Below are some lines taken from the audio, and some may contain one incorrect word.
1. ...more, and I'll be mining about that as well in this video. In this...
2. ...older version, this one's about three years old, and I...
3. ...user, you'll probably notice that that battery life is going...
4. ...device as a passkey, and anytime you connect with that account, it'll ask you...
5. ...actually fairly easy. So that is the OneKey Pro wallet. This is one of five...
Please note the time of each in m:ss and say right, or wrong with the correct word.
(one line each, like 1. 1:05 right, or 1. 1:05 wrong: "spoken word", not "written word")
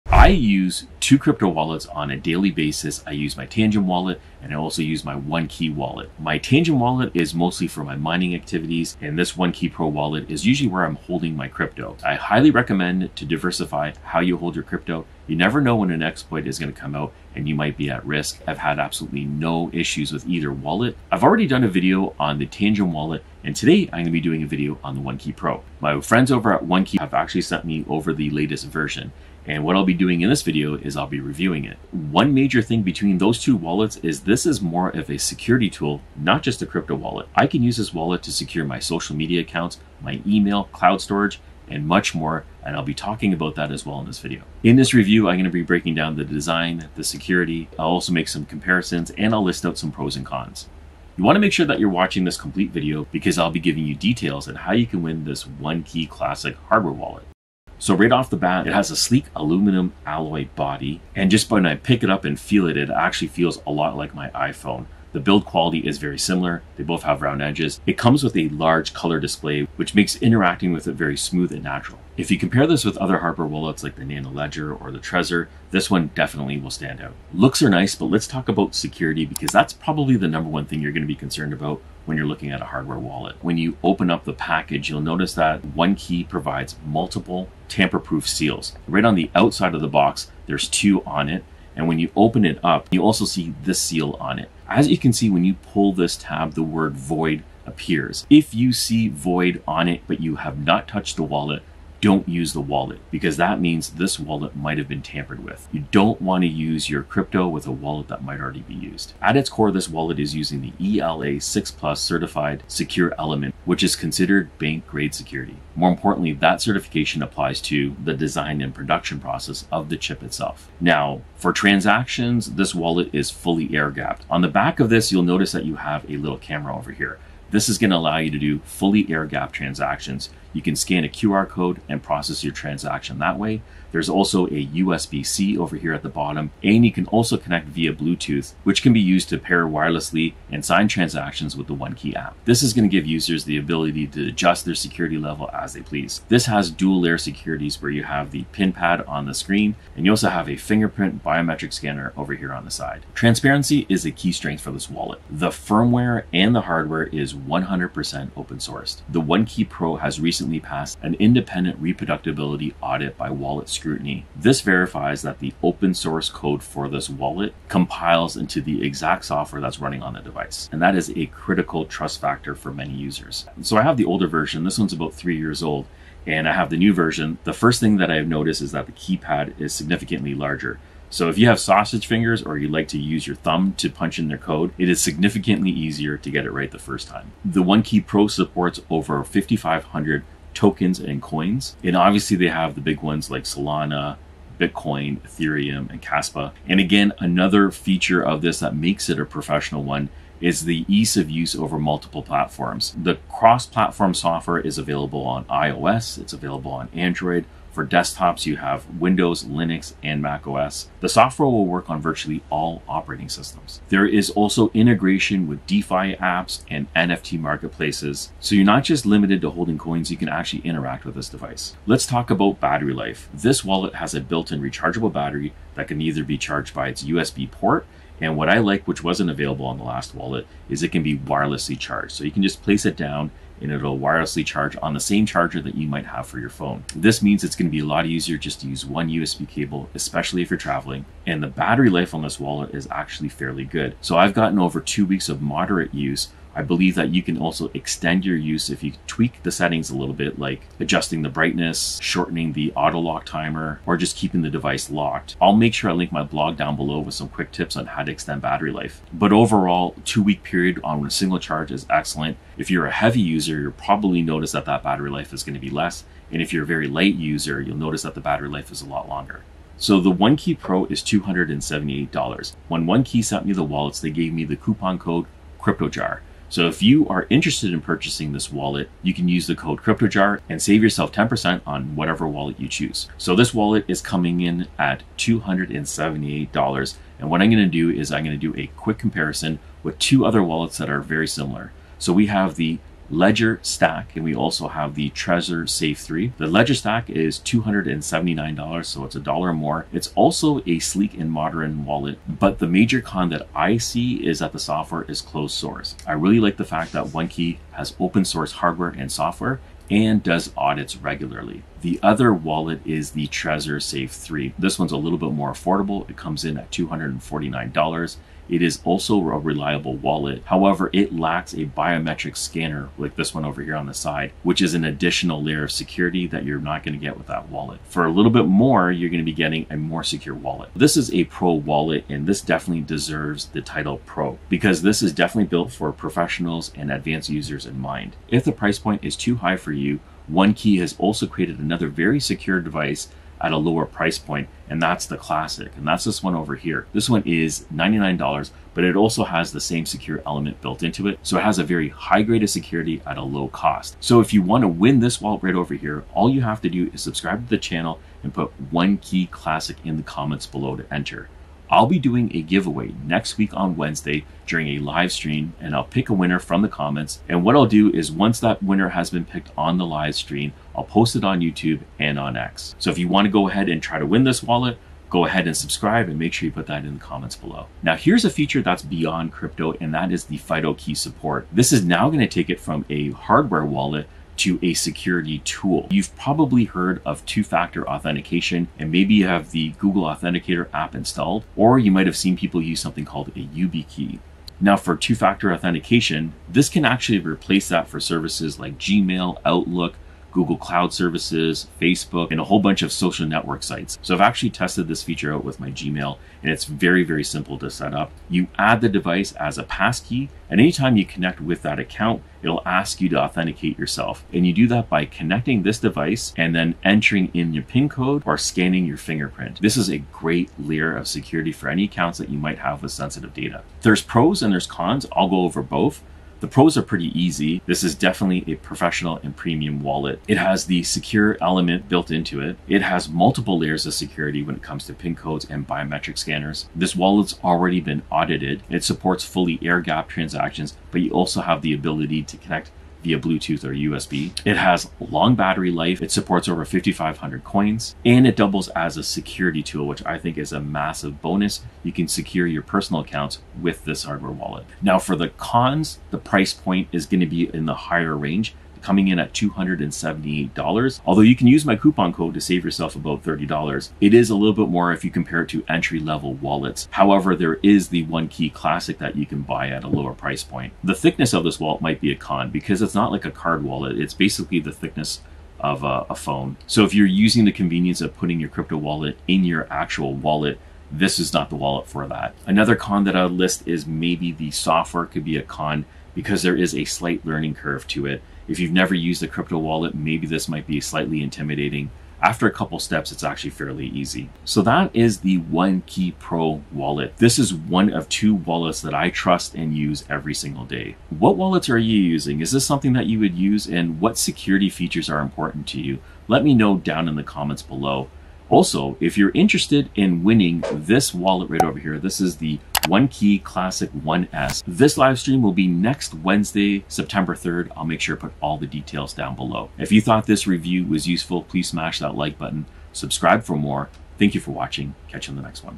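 1. 0:42 wrong: "talking", not "mining"
2. 2:54 right
3. 4:23 right
4. 6:48 right
5. 8:13 wrong: "two", not "five".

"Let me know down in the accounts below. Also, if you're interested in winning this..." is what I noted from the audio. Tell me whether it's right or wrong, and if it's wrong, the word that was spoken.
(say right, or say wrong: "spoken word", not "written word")
wrong: "comments", not "accounts".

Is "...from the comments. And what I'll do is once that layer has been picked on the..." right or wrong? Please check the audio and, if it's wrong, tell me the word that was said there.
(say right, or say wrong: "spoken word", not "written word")
wrong: "winner", not "layer".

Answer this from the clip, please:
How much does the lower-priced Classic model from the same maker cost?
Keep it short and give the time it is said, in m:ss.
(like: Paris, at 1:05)
$99, at 5:46.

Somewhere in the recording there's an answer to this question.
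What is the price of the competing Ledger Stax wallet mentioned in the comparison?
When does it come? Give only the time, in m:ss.
4:56.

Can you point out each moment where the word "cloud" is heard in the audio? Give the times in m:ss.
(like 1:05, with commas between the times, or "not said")
0:40, 6:40.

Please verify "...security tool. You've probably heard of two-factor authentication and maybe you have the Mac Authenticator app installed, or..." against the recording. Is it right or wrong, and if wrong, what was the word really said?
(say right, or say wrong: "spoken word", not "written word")
wrong: "Google", not "Mac".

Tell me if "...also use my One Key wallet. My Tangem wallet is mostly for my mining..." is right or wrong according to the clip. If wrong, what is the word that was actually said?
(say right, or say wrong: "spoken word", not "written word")
right.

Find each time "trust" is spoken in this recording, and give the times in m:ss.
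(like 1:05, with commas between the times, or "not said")
2:51, 8:19.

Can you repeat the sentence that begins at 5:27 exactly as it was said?
For a little bit more, you're going to be getting a more secure wallet.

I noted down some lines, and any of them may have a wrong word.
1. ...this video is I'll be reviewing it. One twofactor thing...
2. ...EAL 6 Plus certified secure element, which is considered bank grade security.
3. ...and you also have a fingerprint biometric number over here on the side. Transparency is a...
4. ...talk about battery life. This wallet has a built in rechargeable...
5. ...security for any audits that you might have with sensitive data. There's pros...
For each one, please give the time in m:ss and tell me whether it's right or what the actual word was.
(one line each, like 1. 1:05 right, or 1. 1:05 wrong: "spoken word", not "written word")
1. 0:30 wrong: "major", not "twofactor"
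2. 1:50 right
3. 2:29 wrong: "scanner", not "number"
4. 3:42 right
5. 7:01 wrong: "accounts", not "audits".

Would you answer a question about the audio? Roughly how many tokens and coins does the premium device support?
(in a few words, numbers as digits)
over 5,500.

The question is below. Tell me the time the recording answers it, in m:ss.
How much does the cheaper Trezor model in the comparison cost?
5:16.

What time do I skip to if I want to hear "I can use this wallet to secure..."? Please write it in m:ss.
0:37.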